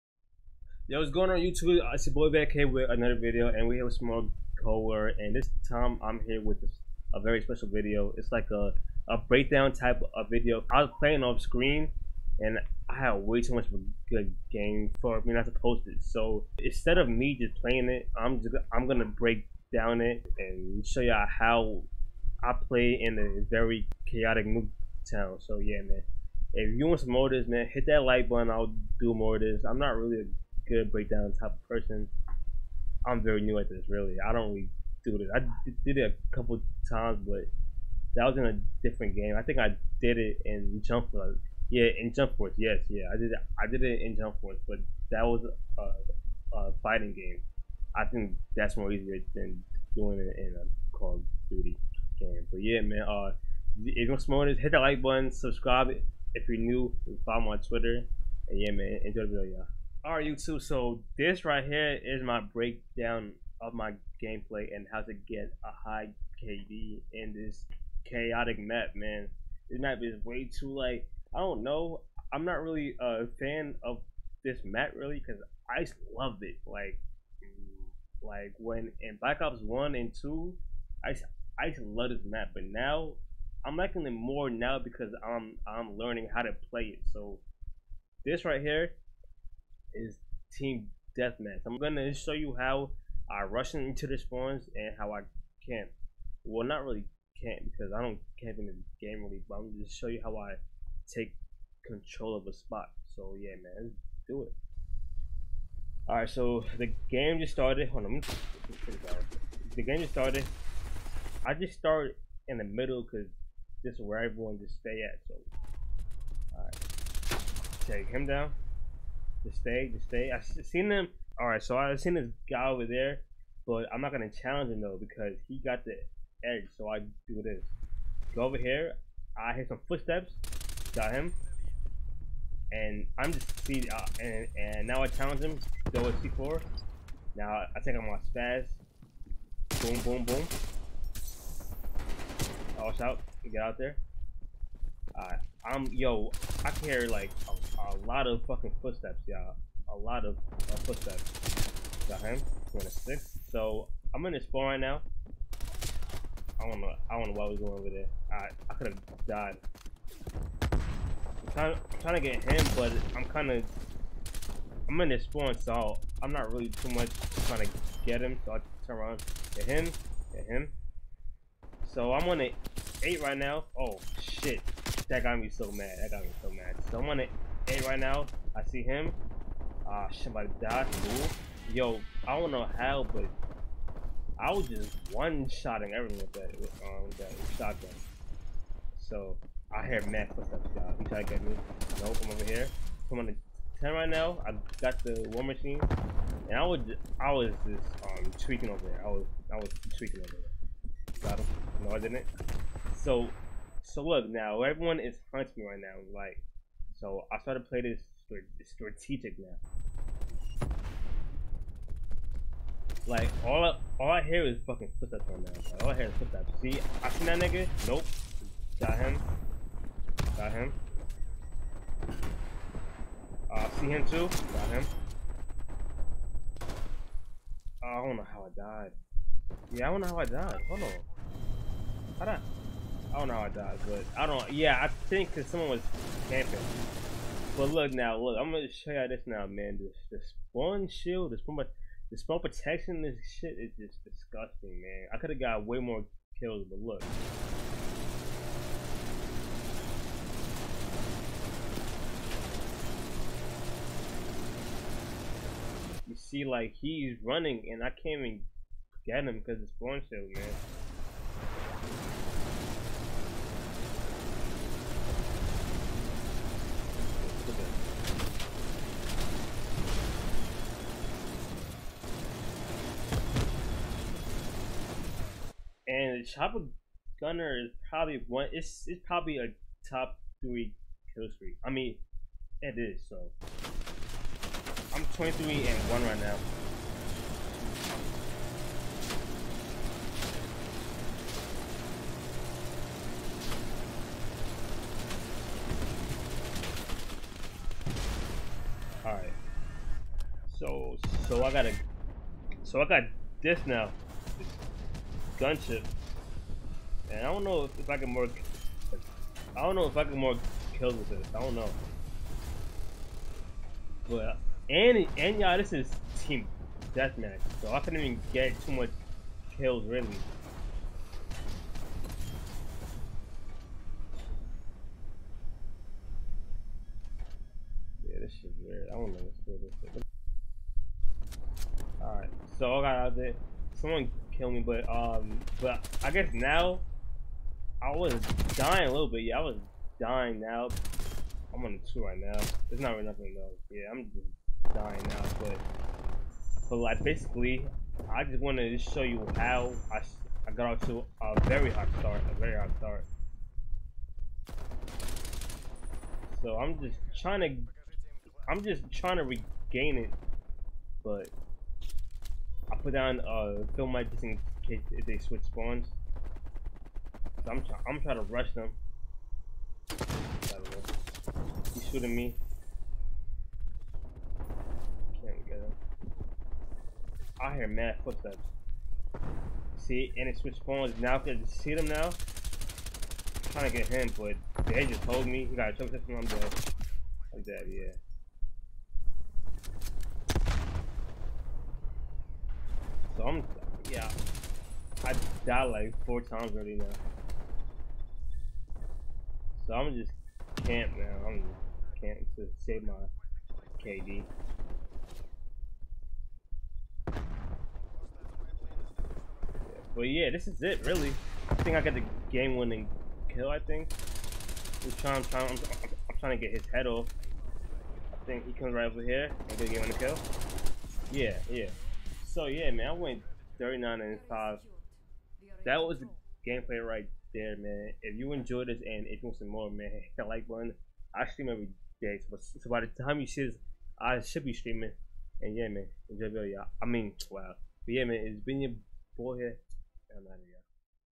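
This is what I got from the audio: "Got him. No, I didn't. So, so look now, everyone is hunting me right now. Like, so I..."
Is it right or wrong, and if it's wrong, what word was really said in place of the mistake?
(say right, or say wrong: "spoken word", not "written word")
right.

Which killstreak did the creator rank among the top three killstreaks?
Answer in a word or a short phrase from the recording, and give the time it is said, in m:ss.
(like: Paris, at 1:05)
Chopper Gunner, at 4:36.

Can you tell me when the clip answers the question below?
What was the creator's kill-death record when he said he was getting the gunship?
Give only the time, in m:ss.
4:45.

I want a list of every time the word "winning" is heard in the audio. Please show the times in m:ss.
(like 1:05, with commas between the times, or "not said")
6:52, 6:59.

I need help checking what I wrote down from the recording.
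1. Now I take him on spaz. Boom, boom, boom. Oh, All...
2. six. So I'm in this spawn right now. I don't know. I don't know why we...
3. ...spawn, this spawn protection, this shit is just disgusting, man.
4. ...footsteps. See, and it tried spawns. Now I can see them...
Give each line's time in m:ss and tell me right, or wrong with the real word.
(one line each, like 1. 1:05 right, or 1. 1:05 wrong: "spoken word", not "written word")
1. 2:17 right
2. 2:32 right
3. 4:01 right
4. 6:18 wrong: "switched", not "tried".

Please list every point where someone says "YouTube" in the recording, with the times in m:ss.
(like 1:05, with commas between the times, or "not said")
0:01, 1:00.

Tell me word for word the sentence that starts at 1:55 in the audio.
So, all right, take him down.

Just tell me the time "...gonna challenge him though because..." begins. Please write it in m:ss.
2:04.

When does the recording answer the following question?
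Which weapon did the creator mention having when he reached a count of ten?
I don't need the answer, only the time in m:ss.
3:15.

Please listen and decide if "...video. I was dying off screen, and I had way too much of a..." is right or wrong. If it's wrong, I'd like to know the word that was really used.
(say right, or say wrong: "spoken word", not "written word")
wrong: "playing", not "dying".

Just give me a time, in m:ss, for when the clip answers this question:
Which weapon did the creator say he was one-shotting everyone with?
3:07.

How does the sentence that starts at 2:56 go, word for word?
Someone at A right now, I see him.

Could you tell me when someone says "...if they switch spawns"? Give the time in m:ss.
6:04.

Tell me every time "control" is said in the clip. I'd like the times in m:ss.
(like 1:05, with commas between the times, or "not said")
1:41.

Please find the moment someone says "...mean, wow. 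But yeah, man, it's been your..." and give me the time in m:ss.
7:16.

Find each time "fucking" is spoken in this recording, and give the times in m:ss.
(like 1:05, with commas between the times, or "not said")
2:28, 3:34.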